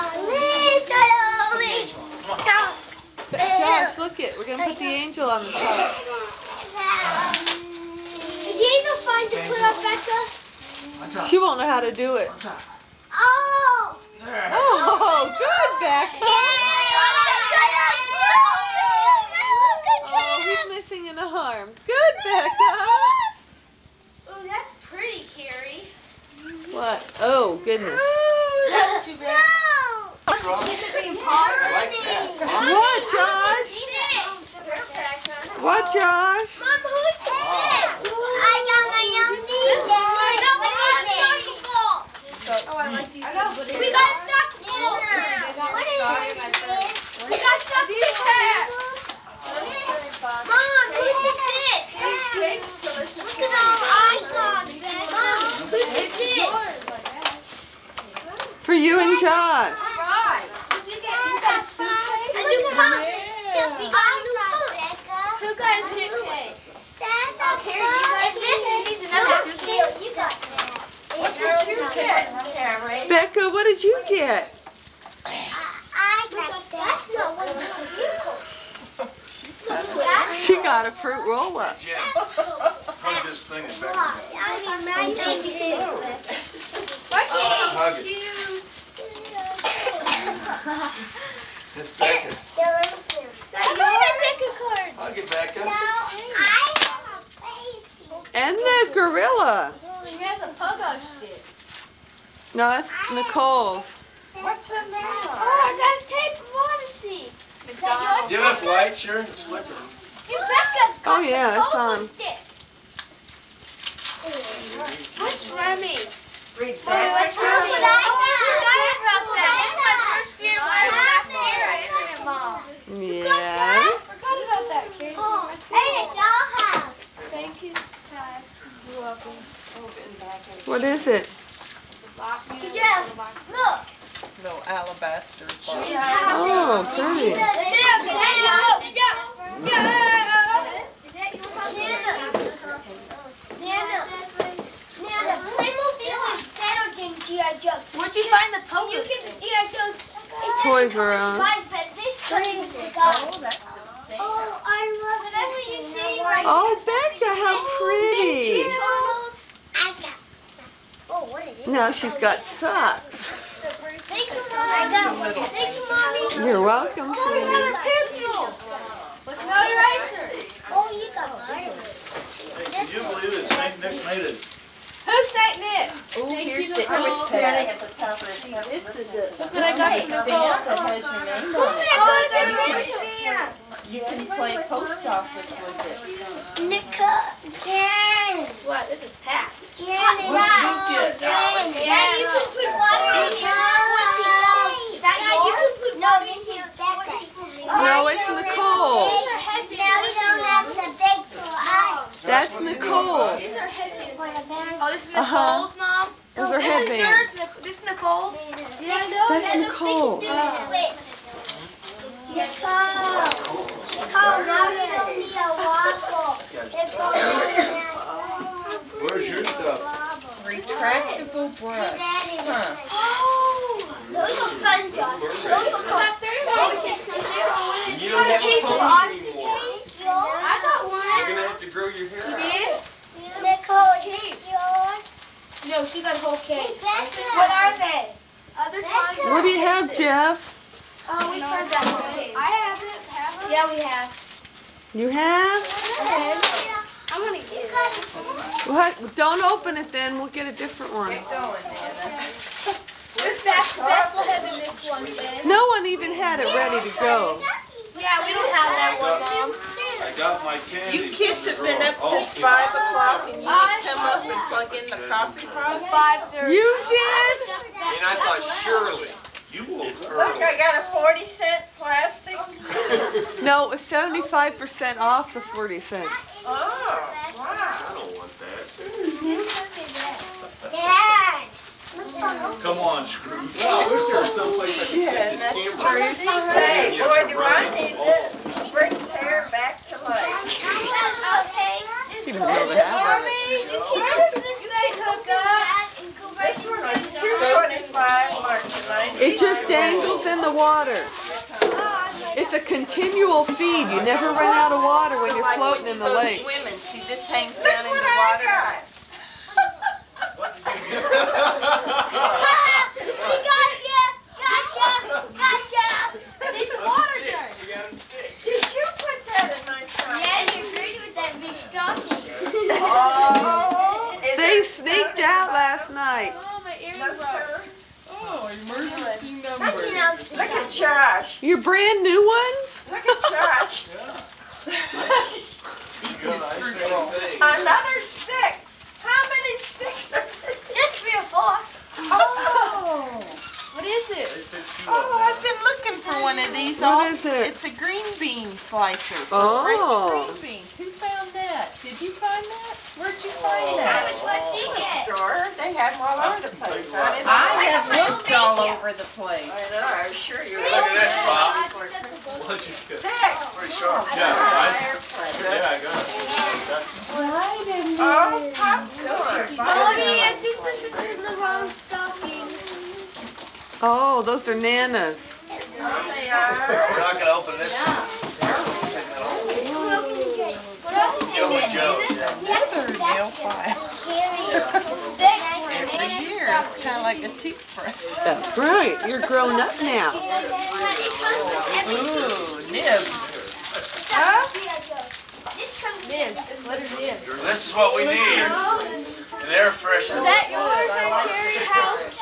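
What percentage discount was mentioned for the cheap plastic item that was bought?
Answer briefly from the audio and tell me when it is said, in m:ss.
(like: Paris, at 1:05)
75%, at 4:33.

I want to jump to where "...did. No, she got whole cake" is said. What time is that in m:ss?
3:52.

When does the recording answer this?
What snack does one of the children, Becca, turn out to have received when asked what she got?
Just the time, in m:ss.
1:20.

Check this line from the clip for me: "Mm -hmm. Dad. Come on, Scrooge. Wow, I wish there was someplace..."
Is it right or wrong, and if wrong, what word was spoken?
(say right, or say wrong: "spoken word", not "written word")
right.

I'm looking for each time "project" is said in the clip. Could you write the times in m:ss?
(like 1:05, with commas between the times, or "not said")
not said.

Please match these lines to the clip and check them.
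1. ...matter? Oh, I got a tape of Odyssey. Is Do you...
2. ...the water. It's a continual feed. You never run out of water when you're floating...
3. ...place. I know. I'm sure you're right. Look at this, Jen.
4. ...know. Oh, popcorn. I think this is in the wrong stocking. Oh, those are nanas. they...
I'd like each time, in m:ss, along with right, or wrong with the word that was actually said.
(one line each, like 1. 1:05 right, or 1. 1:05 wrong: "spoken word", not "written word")
1. 1:44 right
2. 5:00 right
3. 5:59 wrong: "Bob", not "Jen"
4. 6:07 right.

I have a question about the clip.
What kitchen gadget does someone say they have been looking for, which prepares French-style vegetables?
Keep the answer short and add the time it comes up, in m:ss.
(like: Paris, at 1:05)
green bean slicer, at 5:47.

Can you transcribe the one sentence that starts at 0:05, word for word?
Is um, the angel fine to put on Becca?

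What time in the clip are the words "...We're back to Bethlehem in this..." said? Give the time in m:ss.
4:13.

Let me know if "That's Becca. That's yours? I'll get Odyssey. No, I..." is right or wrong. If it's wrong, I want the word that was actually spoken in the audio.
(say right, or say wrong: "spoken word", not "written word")
wrong: "Becca", not "Odyssey".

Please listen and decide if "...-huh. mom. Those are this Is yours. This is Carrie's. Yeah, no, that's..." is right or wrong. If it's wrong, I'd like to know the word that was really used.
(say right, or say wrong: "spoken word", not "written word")
wrong: "Nicole", not "Carrie".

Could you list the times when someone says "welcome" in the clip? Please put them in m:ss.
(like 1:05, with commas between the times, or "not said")
2:09, 2:46.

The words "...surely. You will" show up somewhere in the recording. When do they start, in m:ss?
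4:28.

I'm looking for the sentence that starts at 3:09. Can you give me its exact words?
Jen, Jen, Jen, oh, you can put water in here.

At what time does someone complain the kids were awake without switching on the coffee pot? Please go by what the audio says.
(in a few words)
5 o'clock.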